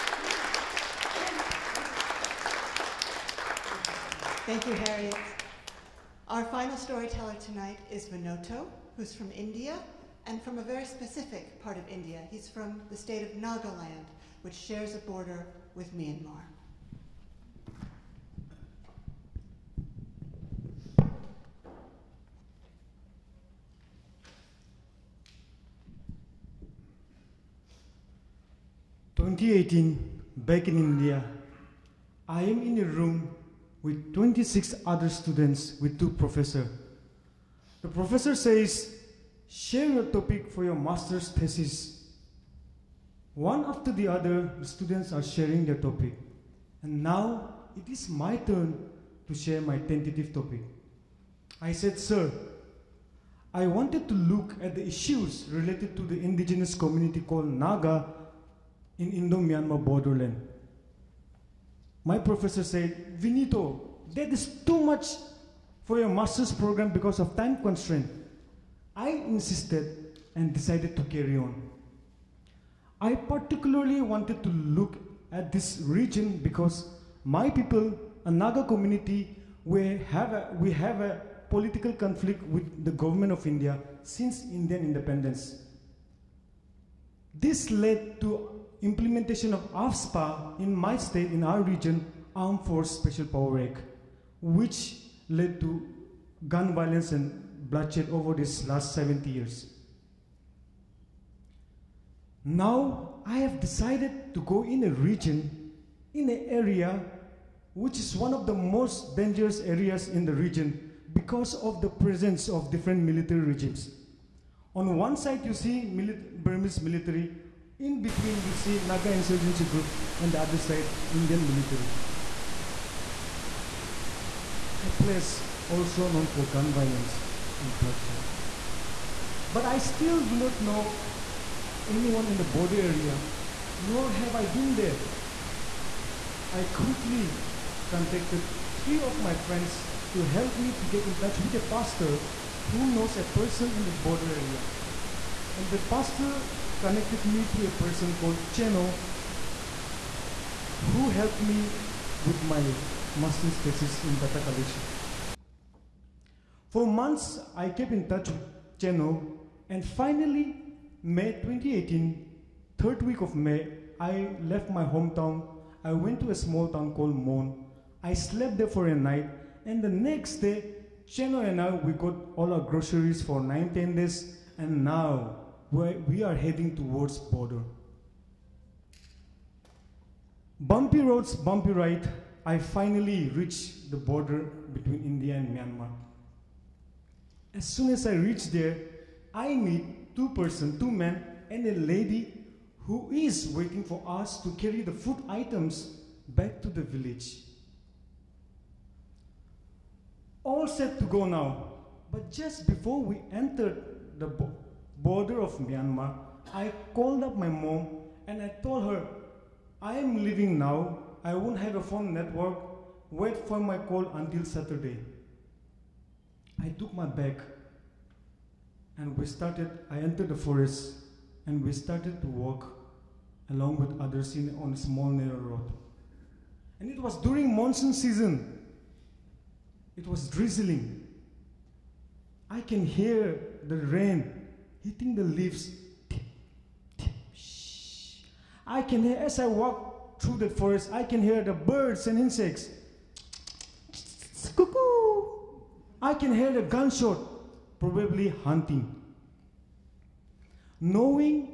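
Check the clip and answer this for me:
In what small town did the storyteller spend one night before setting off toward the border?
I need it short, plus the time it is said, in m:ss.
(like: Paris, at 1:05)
Mon, at 2:47.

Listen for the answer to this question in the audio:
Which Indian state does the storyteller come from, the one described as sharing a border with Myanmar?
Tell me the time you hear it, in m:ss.
0:13.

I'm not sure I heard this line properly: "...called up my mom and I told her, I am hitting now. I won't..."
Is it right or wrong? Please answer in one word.
wrong.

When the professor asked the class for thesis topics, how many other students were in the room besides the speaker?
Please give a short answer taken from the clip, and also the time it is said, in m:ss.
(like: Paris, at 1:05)
26, at 0:34.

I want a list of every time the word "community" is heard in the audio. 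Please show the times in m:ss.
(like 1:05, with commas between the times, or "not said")
0:56, 1:18.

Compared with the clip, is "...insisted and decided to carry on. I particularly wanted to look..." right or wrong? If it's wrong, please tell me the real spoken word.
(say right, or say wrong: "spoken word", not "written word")
right.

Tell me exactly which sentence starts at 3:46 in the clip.
And it was during monsoon season.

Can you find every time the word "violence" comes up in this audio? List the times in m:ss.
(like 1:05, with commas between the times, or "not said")
1:36, 2:06.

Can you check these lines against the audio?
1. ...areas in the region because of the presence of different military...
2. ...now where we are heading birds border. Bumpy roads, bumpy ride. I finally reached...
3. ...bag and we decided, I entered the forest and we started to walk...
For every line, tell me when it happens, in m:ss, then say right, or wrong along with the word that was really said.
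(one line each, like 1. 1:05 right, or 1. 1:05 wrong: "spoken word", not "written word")
1. 1:49 right
2. 2:54 wrong: "towards", not "birds"
3. 3:37 wrong: "started", not "decided".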